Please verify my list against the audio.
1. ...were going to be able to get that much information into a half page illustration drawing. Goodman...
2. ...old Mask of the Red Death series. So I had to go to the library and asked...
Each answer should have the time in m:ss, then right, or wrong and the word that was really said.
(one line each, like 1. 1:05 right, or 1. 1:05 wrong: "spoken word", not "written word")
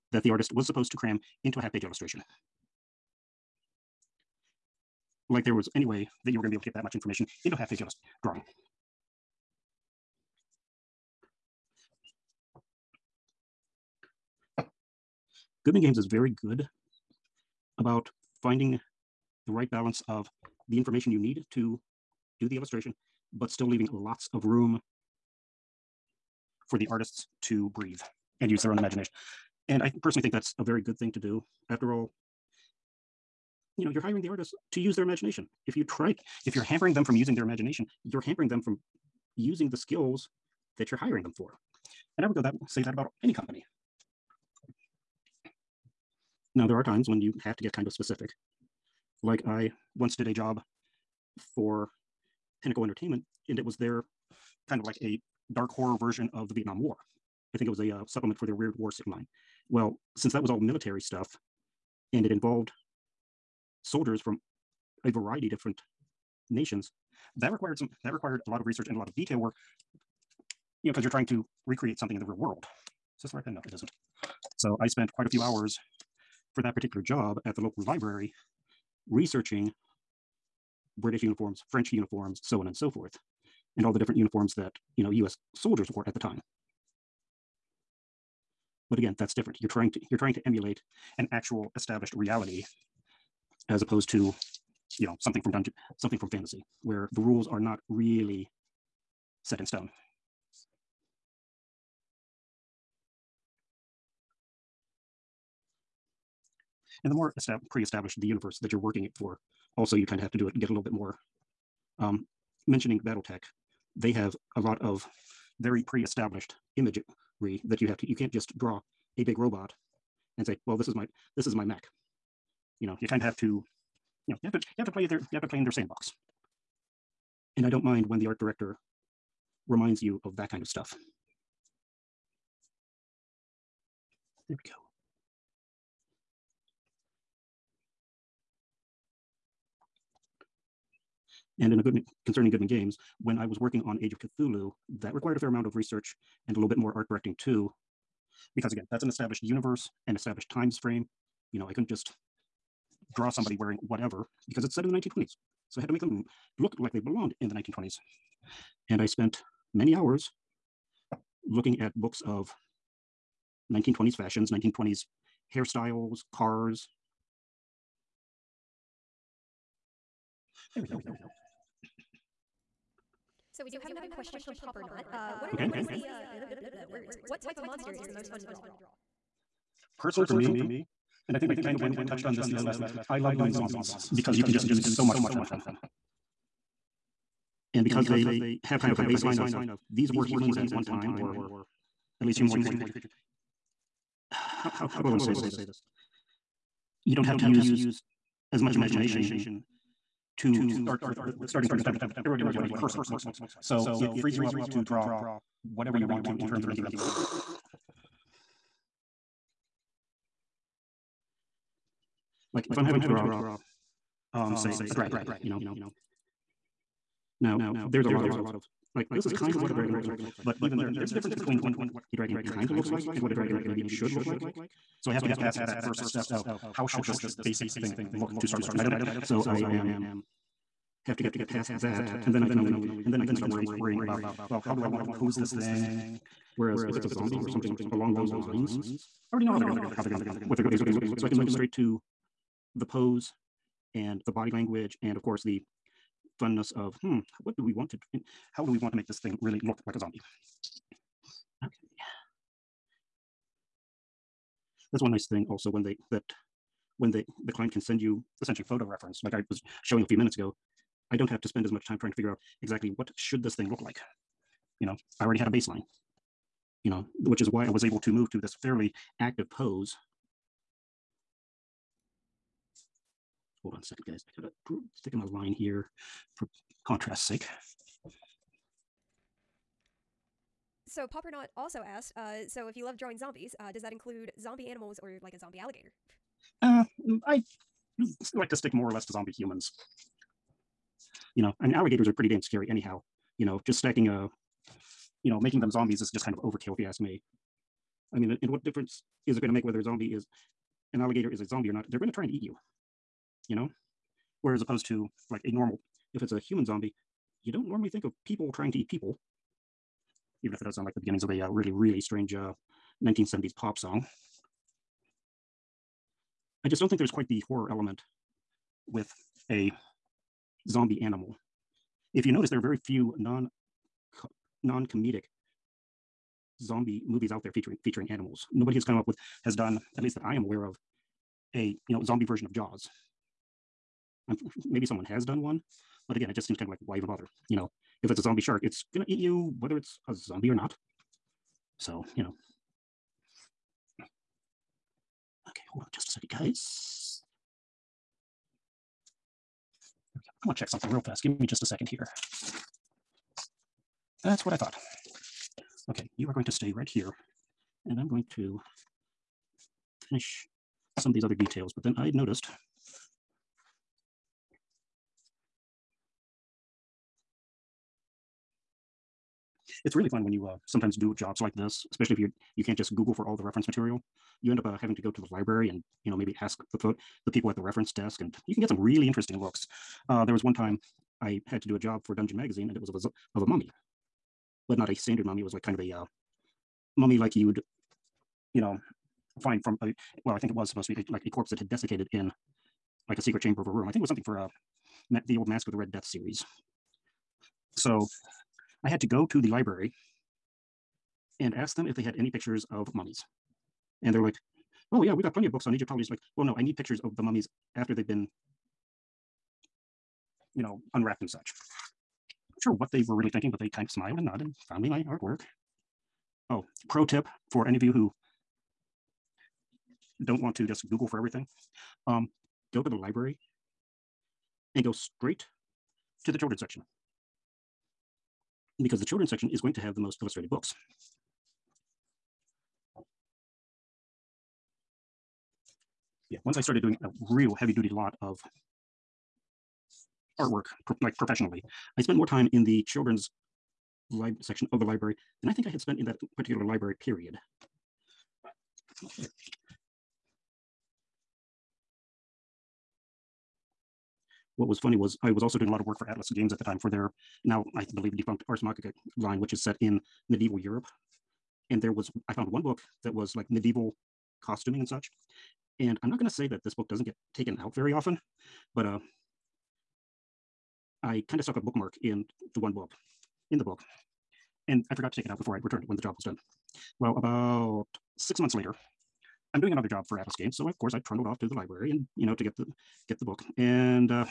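1. 0:06 right
2. 6:35 right.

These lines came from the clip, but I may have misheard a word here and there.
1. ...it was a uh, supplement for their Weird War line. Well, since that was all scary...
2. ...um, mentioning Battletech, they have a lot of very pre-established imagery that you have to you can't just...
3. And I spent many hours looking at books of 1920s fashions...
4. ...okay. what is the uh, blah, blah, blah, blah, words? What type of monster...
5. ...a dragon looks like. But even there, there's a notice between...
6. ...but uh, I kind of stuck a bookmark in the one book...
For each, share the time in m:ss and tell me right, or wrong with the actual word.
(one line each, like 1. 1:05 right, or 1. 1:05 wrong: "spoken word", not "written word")
1. 0:57 wrong: "military", not "scary"
2. 1:51 right
3. 2:38 right
4. 2:55 right
5. 3:39 wrong: "difference", not "notice"
6. 7:48 right.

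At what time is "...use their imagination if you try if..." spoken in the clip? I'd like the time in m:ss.
0:34.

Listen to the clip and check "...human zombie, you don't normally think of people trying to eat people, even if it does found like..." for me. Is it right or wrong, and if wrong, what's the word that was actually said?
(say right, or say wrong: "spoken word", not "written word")
wrong: "sound", not "found".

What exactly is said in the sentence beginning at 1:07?
That required some that required a lot of research and a lot of detail work.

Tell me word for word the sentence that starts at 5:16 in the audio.
I just don't think there's quite the horror element with a zombie animal.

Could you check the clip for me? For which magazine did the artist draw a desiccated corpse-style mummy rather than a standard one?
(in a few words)
Dungeon Magazine.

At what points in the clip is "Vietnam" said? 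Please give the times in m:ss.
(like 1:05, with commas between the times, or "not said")
0:56.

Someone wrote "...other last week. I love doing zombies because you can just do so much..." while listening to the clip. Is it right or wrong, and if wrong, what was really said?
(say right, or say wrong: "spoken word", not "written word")
right.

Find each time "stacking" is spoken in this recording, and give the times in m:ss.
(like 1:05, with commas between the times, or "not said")
4:53.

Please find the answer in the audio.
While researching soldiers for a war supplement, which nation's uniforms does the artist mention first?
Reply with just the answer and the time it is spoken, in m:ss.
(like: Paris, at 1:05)
British, at 1:21.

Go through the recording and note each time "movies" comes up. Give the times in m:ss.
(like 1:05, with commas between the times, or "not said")
5:27.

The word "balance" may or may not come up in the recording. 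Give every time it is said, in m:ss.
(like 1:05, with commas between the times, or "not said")
0:19.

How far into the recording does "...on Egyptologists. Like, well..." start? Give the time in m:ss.
6:45.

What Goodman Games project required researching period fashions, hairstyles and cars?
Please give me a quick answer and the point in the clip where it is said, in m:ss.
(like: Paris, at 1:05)
Age of Cthulhu, at 2:24.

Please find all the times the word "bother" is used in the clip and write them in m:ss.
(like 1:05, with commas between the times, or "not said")
5:37.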